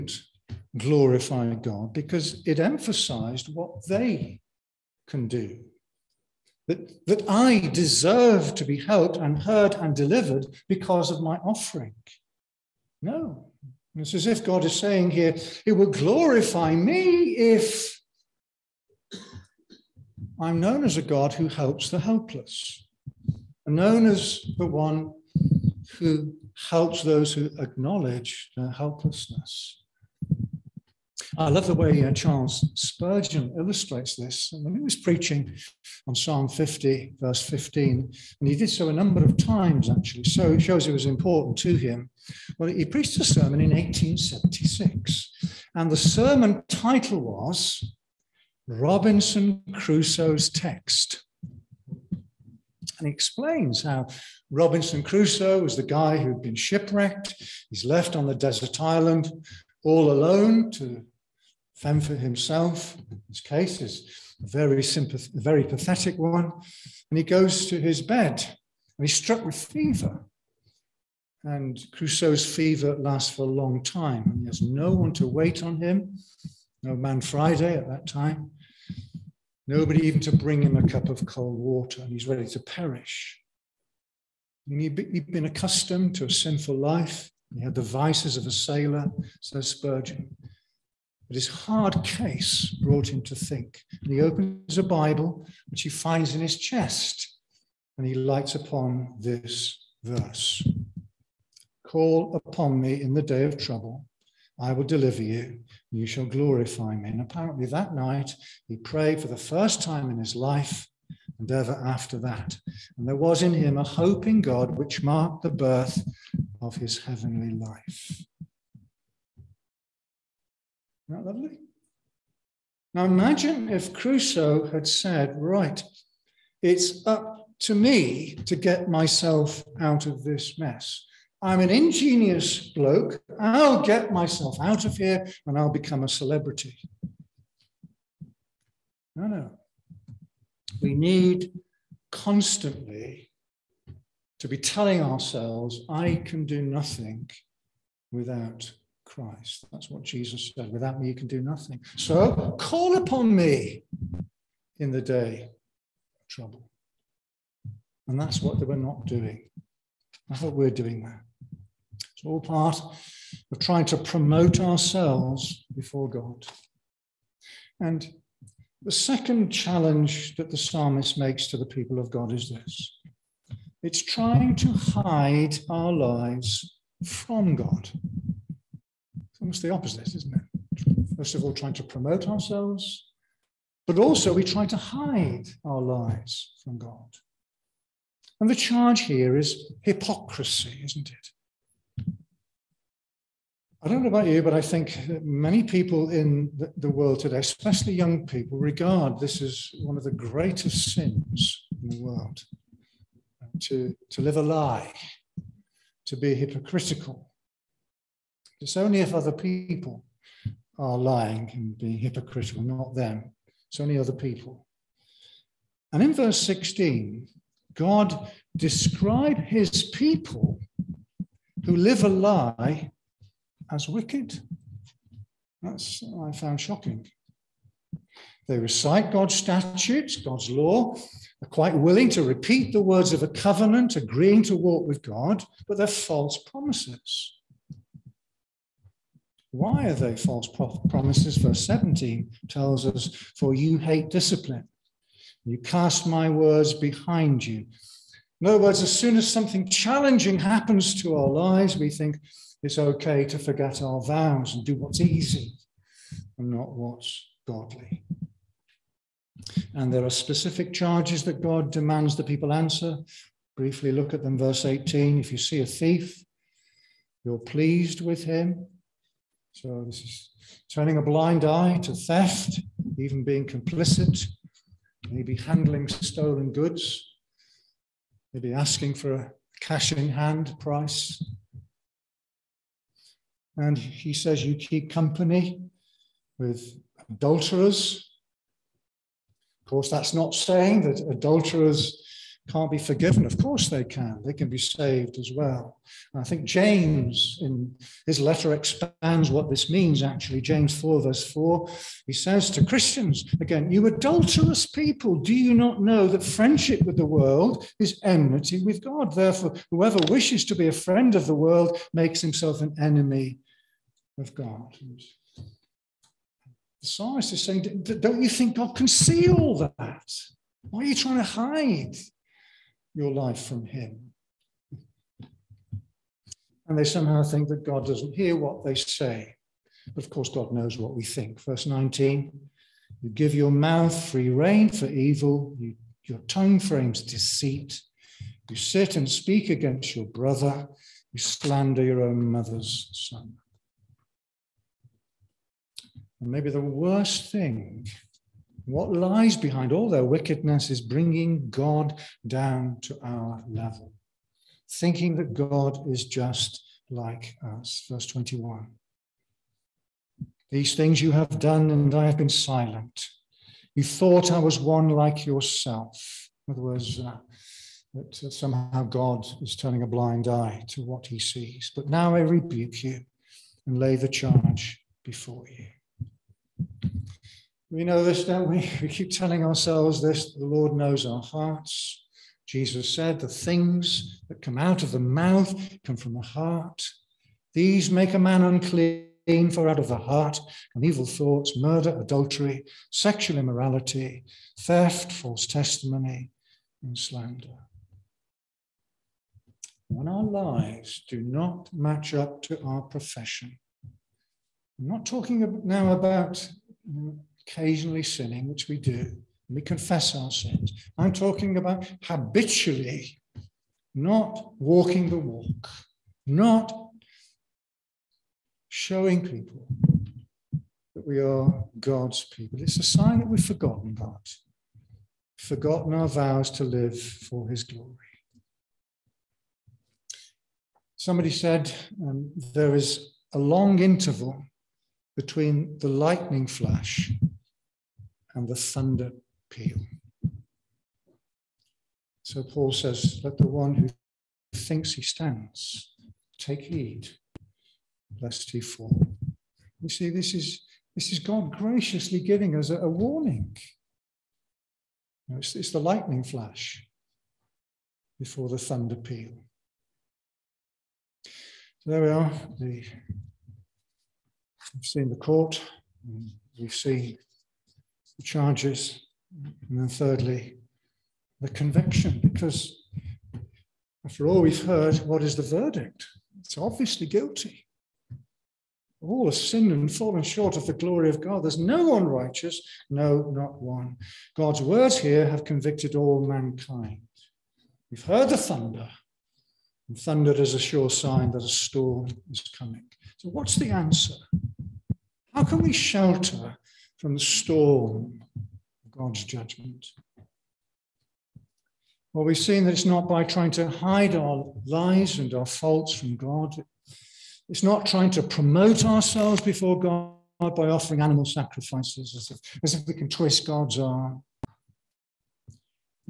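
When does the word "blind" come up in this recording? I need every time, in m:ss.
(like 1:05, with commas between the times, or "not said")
4:31, 6:09.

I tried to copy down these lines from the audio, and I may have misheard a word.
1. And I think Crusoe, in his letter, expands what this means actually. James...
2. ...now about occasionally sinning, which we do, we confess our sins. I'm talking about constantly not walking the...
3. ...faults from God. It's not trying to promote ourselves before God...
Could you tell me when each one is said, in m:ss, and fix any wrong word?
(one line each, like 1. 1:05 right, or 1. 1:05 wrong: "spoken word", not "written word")
1. 4:56 wrong: "James", not "Crusoe"
2. 6:45 wrong: "habitually", not "constantly"
3. 8:25 right.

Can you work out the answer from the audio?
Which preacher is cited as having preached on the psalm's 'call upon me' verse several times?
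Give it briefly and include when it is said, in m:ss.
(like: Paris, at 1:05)
Charles Spurgeon, at 0:32.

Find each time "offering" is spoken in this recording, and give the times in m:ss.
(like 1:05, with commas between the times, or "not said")
0:11, 8:30.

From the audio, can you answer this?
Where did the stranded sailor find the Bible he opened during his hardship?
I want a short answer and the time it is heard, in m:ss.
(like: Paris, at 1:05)
in his chest, at 1:36.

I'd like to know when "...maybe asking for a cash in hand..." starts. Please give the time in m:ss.
4:38.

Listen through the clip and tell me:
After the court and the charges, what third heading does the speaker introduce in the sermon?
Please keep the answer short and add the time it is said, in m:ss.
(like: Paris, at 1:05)
the conviction, at 7:51.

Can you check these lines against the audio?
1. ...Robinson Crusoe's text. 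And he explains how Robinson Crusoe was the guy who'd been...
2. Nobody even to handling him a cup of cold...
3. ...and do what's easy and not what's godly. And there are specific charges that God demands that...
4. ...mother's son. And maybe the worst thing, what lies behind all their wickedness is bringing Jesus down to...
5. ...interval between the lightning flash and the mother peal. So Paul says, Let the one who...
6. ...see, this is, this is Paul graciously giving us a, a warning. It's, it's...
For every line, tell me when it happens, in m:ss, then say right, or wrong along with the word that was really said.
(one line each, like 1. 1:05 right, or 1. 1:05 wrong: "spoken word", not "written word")
1. 0:48 right
2. 1:19 wrong: "bring", not "handling"
3. 4:14 right
4. 5:42 wrong: "God", not "Jesus"
5. 7:13 wrong: "thunder", not "mother"
6. 7:29 wrong: "God", not "Paul".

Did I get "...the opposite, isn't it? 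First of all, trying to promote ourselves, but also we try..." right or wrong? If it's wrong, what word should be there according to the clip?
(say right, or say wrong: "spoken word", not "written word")
right.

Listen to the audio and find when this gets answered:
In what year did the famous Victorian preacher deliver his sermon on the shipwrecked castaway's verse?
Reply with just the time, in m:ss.
0:43.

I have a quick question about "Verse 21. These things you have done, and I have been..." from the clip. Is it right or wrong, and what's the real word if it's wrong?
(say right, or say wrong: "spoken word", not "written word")
right.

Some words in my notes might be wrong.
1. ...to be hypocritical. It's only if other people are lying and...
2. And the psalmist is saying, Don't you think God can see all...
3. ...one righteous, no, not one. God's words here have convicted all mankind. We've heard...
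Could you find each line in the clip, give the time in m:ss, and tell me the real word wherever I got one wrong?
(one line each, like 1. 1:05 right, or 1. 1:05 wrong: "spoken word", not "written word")
1. 3:26 right
2. 5:14 right
3. 8:01 right.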